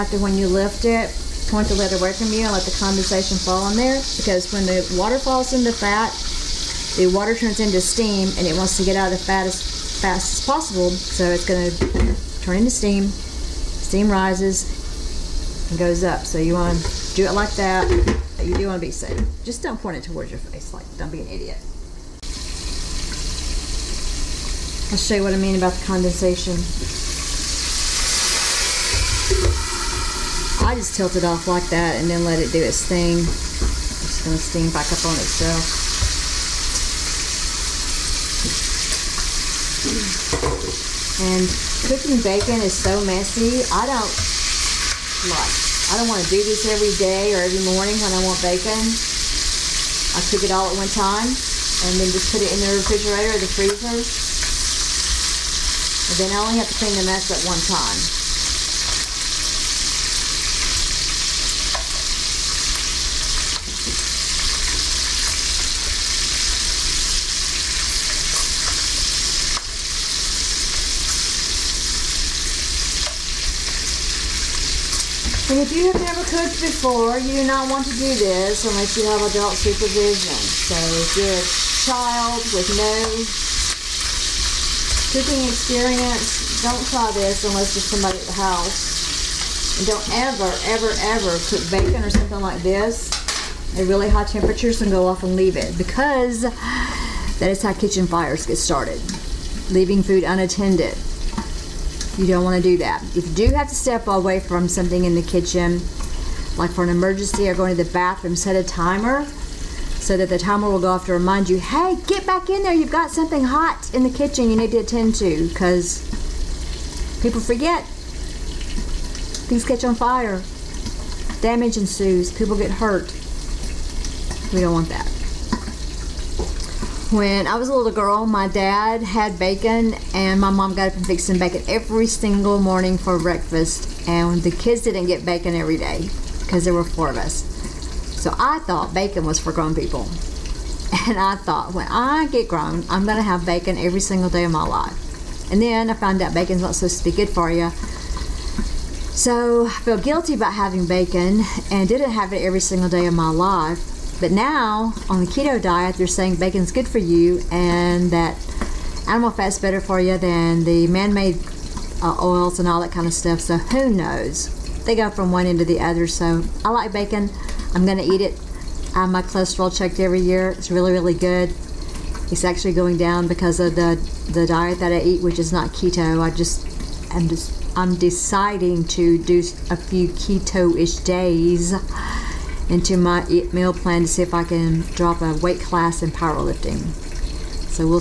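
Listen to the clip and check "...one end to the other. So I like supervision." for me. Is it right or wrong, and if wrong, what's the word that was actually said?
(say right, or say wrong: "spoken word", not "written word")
wrong: "bacon", not "supervision".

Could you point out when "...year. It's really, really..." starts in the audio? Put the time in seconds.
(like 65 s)
170 s.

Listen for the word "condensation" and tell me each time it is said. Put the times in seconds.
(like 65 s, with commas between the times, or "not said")
2 s, 25 s.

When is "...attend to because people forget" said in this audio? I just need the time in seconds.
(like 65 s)
114 s.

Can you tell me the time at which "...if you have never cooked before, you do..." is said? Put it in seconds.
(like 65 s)
75 s.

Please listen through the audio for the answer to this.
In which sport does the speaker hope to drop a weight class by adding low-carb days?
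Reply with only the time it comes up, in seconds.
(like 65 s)
186 s.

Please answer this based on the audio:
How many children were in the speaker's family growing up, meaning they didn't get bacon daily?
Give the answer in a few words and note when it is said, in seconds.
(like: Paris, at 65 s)
4, at 136 s.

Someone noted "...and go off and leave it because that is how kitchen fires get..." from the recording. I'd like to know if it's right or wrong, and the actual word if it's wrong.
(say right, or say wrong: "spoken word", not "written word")
right.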